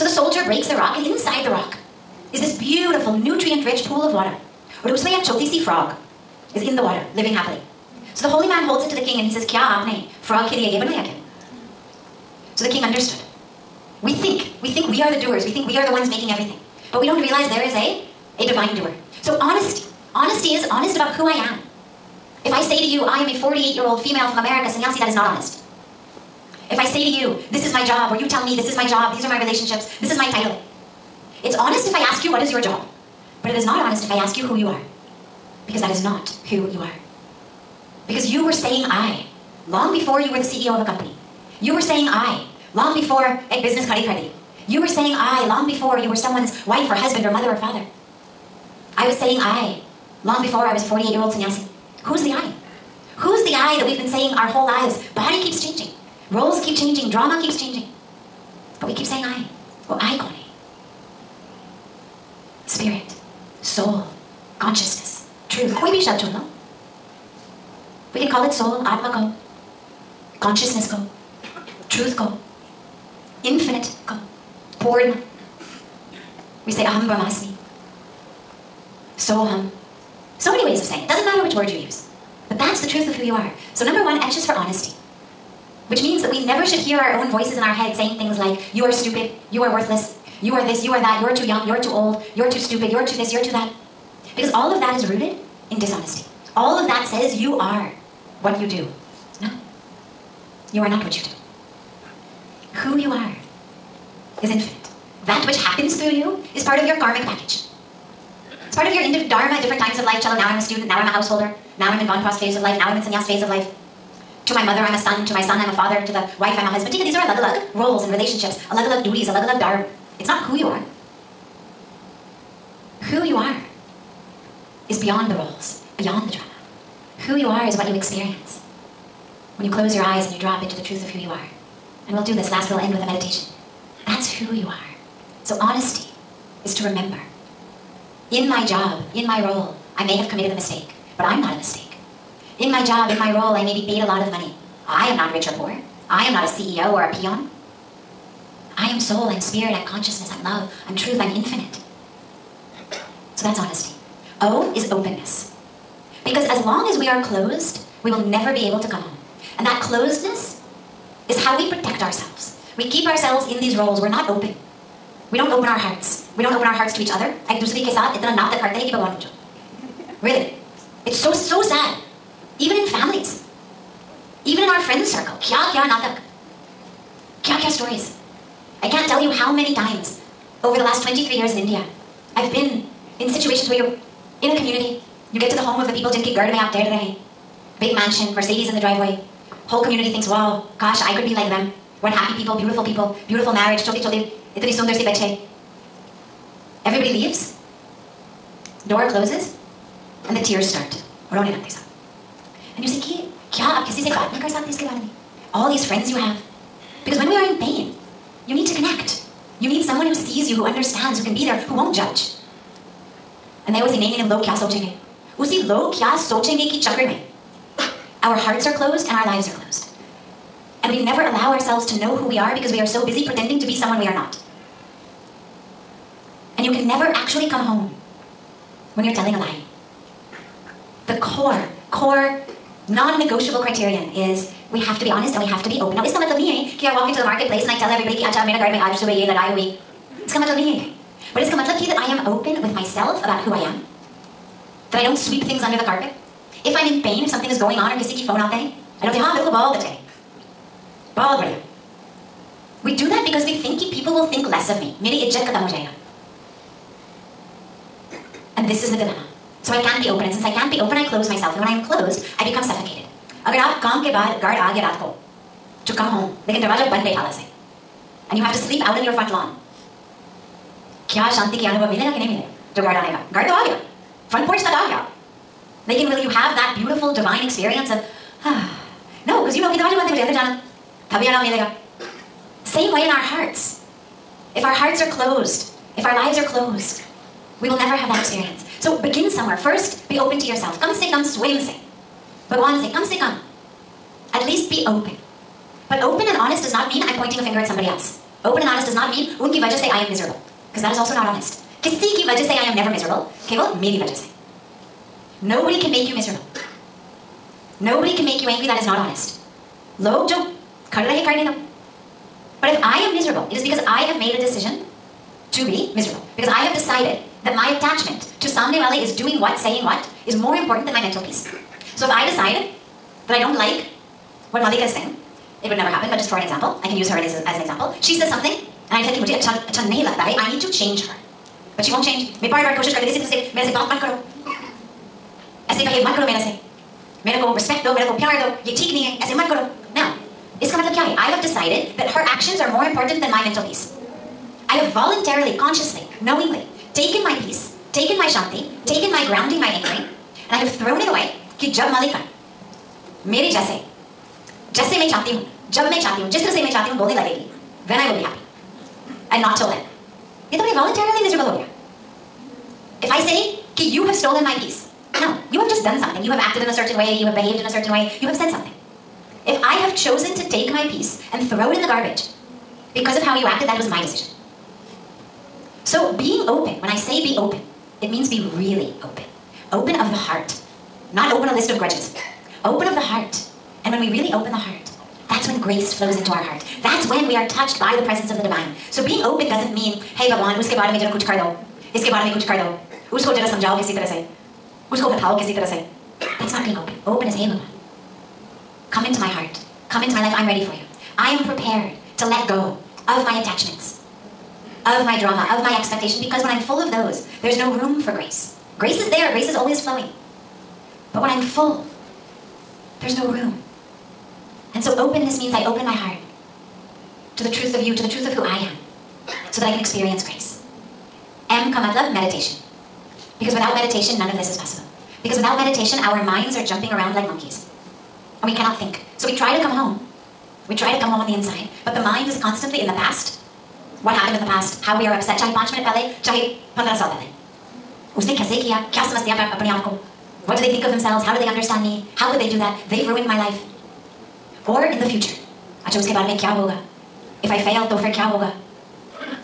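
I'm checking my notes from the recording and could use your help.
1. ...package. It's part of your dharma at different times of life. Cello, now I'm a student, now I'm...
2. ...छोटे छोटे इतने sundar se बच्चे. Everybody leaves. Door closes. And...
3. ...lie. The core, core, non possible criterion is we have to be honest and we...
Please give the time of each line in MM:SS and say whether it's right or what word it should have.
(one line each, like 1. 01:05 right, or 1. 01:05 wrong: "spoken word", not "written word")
1. 01:47 right
2. 03:13 right
3. 03:49 wrong: "negotiable", not "possible".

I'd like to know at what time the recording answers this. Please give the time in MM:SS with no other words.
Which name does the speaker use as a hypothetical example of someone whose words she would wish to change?
05:24.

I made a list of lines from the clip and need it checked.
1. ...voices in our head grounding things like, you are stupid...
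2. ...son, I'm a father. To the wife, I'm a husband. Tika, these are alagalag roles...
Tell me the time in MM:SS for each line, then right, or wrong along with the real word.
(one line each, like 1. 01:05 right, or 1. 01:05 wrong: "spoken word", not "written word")
1. 01:27 wrong: "saying", not "grounding"
2. 01:55 right.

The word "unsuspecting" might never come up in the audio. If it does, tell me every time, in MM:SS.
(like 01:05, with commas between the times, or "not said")
not said.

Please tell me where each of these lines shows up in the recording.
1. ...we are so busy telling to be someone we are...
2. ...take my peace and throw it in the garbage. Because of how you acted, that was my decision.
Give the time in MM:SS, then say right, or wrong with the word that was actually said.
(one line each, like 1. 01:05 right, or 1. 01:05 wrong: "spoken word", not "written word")
1. 03:42 wrong: "pretending", not "telling"
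2. 06:10 right.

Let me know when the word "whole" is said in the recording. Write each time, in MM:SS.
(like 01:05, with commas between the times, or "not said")
00:54, 03:09.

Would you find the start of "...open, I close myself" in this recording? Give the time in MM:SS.
04:20.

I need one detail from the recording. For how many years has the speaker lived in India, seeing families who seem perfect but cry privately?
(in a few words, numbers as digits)
23.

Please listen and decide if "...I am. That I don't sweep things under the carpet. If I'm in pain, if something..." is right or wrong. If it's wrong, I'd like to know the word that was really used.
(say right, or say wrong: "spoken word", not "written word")
right.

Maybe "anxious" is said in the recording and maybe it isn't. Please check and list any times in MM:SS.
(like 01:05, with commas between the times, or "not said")
01:24.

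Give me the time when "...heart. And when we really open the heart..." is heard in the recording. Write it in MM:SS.
06:23.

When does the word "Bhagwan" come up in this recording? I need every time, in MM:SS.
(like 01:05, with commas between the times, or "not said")
04:52, 06:30, 06:37.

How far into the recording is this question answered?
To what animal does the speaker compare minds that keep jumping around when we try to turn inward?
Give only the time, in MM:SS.
07:07.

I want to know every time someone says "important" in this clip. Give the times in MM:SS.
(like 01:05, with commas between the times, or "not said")
05:20, 05:42.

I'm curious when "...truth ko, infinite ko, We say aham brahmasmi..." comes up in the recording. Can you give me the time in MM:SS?
01:11.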